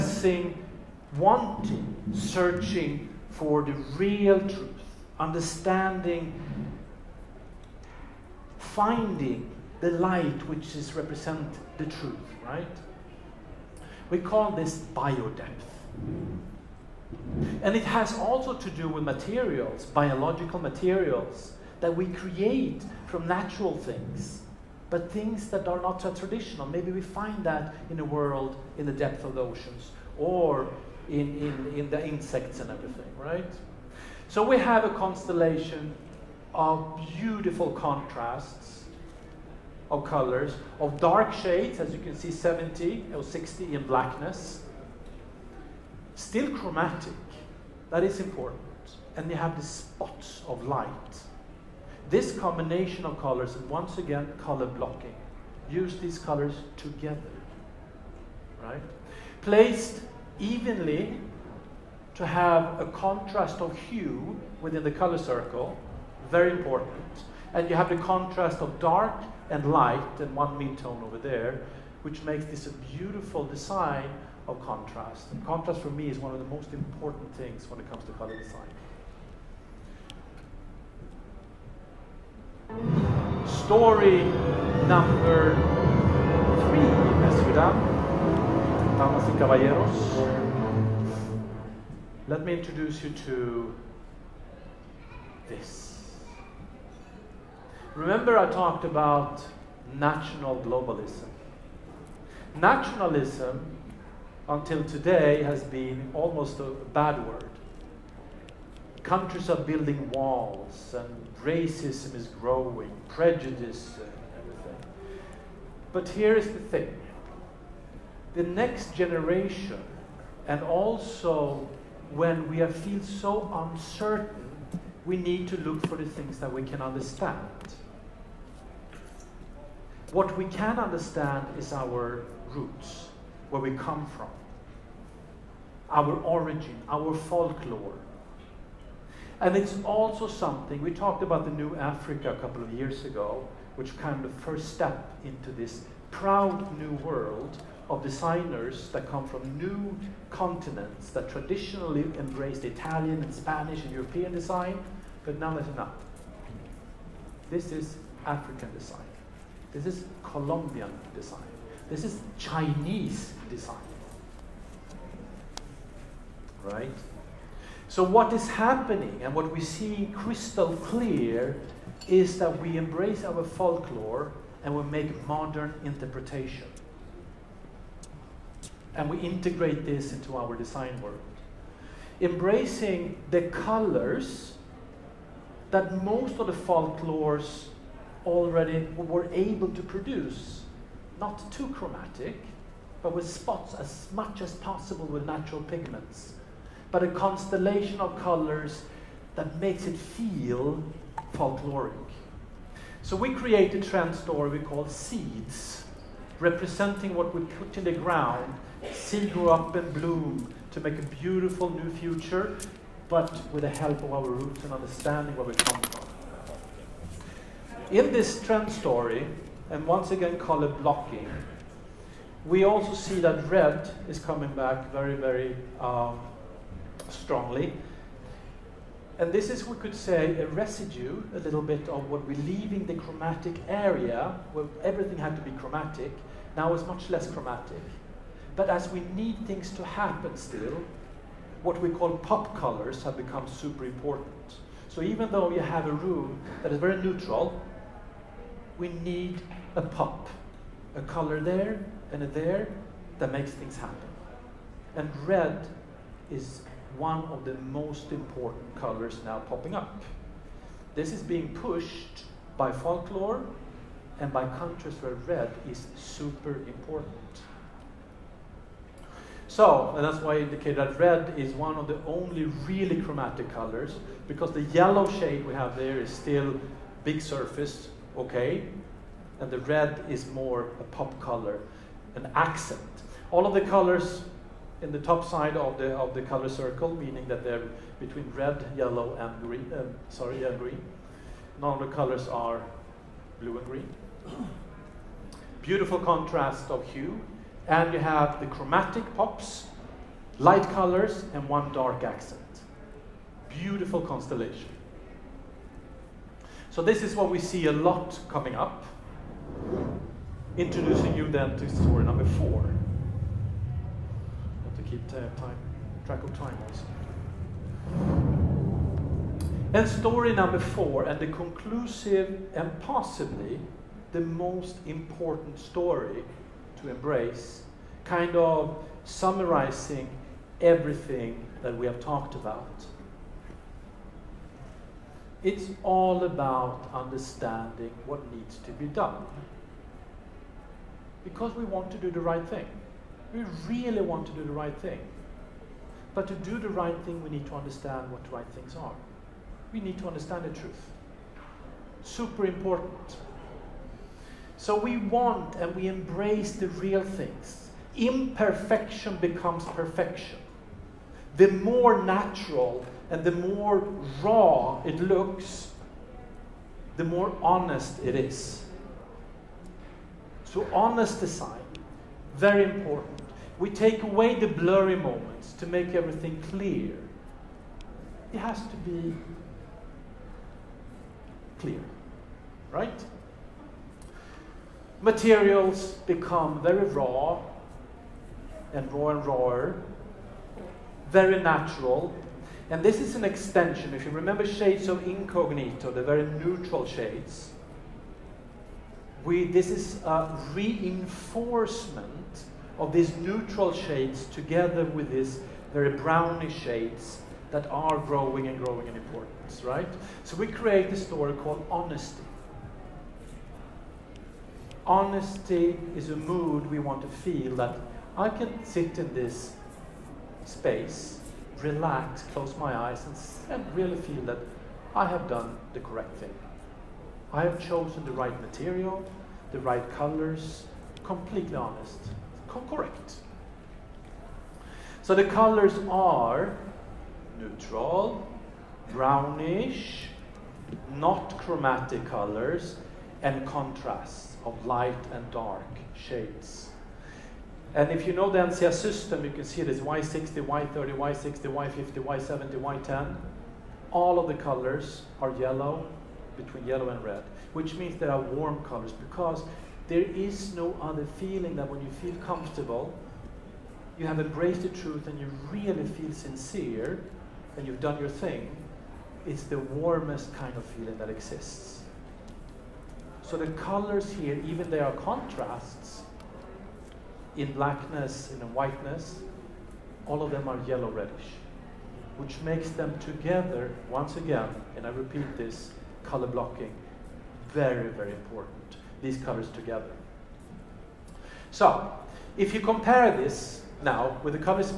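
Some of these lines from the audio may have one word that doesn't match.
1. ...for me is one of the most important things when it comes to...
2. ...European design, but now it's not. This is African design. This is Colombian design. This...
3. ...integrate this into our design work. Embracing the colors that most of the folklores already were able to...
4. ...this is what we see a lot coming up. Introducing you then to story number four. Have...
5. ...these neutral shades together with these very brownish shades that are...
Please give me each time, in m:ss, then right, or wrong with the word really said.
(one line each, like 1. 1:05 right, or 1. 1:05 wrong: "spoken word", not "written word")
1. 1:15 right
2. 2:33 right
3. 2:59 right
4. 5:06 right
5. 6:42 right.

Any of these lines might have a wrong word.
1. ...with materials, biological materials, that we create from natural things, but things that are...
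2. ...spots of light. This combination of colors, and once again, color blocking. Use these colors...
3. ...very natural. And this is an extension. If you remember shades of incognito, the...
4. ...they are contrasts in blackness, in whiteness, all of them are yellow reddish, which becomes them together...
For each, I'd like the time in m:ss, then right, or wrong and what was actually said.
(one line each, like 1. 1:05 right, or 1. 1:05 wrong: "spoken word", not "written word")
1. 0:18 right
2. 0:49 right
3. 6:31 right
4. 7:54 wrong: "makes", not "becomes".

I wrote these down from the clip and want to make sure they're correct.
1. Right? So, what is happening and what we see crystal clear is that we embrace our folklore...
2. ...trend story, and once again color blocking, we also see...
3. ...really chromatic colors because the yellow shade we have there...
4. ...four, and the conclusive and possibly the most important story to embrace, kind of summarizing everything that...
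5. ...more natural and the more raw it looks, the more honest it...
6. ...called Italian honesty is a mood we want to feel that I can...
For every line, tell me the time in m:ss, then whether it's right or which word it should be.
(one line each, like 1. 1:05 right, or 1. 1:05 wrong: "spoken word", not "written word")
1. 2:46 right
2. 3:38 right
3. 4:32 right
4. 5:20 right
5. 6:01 right
6. 6:51 wrong: "Honesty", not "Italian".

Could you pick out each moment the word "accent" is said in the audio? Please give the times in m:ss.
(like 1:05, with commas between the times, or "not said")
4:42, 5:02.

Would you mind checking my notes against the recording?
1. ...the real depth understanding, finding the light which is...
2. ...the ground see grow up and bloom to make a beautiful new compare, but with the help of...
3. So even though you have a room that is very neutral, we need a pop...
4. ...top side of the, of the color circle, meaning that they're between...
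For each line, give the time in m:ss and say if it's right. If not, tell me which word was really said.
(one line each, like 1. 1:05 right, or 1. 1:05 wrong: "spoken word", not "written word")
1. 0:03 wrong: "truth", not "depth"
2. 3:27 wrong: "future", not "compare"
3. 4:04 right
4. 4:44 right.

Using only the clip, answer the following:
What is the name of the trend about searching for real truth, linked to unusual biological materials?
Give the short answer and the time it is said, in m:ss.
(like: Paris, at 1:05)
Biodepth, at 0:14.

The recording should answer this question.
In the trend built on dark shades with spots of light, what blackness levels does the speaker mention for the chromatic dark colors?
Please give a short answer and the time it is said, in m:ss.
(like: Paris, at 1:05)
70 or 60, at 0:42.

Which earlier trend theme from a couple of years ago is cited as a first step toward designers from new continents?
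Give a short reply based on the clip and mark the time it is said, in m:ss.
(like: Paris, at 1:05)
The New Africa, at 2:21.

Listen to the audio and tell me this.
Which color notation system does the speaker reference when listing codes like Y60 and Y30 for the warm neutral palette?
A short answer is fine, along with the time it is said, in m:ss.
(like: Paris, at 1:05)
NCS system, at 7:28.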